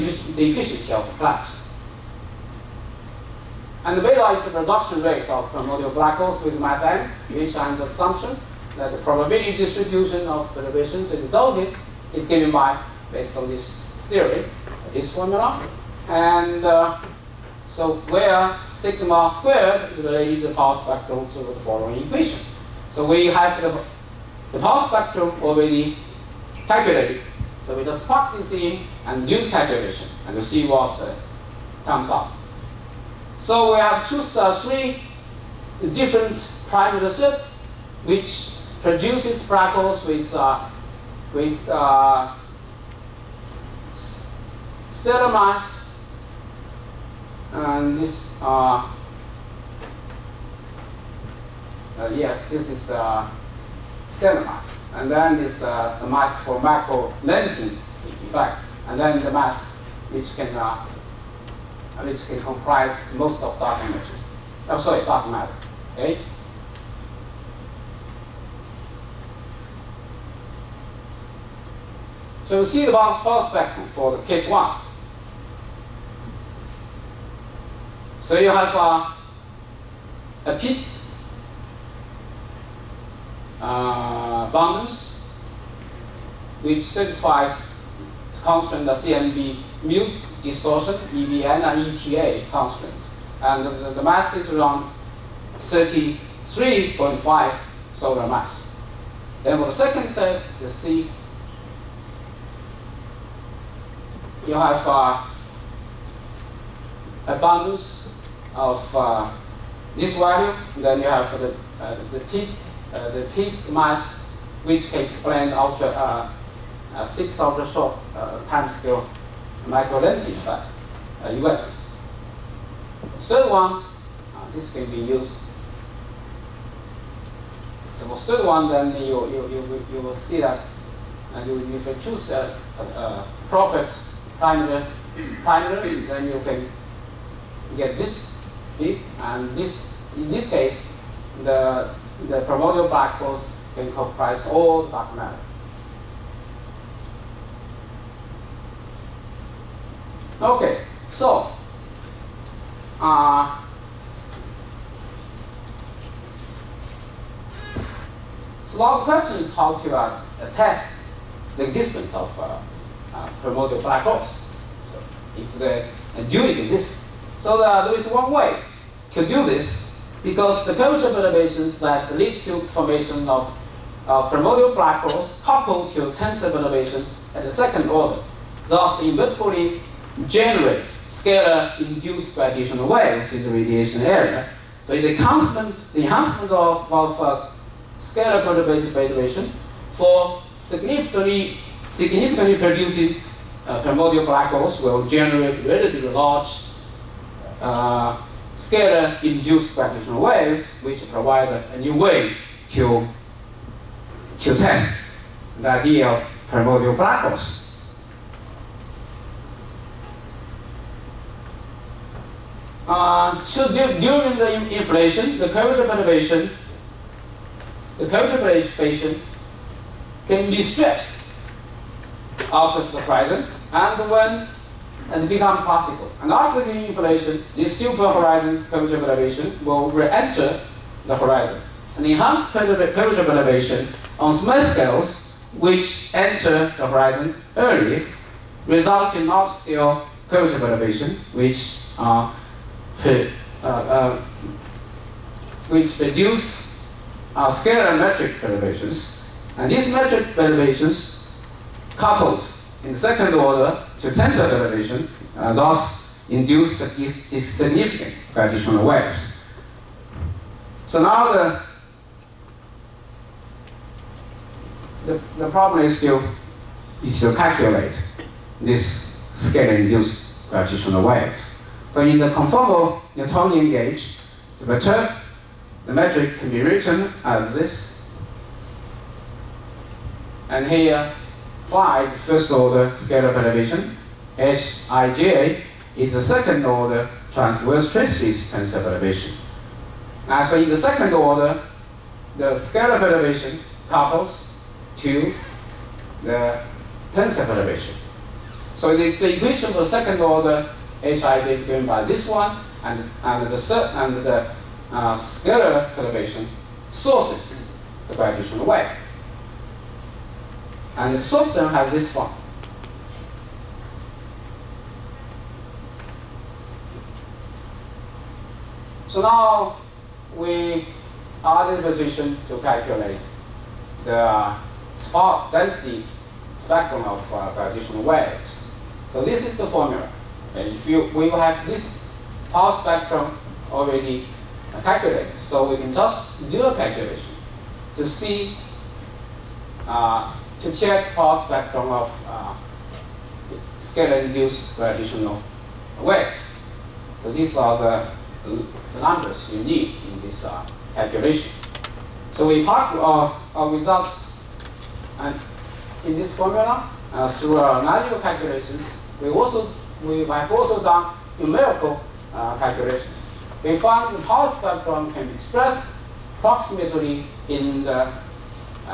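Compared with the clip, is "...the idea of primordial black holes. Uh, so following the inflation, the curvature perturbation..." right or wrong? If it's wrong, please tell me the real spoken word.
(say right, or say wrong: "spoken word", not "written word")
wrong: "during", not "following".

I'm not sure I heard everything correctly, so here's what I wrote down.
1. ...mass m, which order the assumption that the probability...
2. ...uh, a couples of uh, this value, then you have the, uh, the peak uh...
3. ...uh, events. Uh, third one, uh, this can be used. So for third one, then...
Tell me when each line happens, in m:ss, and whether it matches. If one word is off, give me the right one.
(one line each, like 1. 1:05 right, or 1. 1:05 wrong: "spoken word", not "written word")
1. 0:06 wrong: "under", not "order"
2. 1:44 wrong: "bundles", not "couples"
3. 2:00 right.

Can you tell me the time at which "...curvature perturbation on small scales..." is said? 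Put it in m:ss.
3:52.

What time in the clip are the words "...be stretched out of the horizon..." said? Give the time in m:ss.
3:40.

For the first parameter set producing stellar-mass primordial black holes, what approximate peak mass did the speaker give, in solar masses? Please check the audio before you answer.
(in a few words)
33.5.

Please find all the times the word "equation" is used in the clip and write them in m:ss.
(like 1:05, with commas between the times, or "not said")
0:22, 4:59.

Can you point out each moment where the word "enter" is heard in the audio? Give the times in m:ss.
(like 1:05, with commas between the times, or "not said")
3:49, 3:56.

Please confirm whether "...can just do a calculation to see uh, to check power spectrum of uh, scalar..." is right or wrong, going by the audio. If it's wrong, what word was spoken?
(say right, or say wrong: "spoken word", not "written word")
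right.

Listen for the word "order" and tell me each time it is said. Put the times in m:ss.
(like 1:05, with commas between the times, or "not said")
2:57, 4:13, 4:42, 4:46, 4:51, 5:00.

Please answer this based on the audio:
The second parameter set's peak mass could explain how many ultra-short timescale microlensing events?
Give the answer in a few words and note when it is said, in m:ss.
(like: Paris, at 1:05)
6, at 1:57.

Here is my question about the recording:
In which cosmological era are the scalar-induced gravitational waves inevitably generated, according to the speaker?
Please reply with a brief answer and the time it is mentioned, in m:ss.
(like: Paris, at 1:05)
radiation era, at 3:03.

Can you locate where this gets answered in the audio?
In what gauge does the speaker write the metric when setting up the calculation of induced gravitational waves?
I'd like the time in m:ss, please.
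4:32.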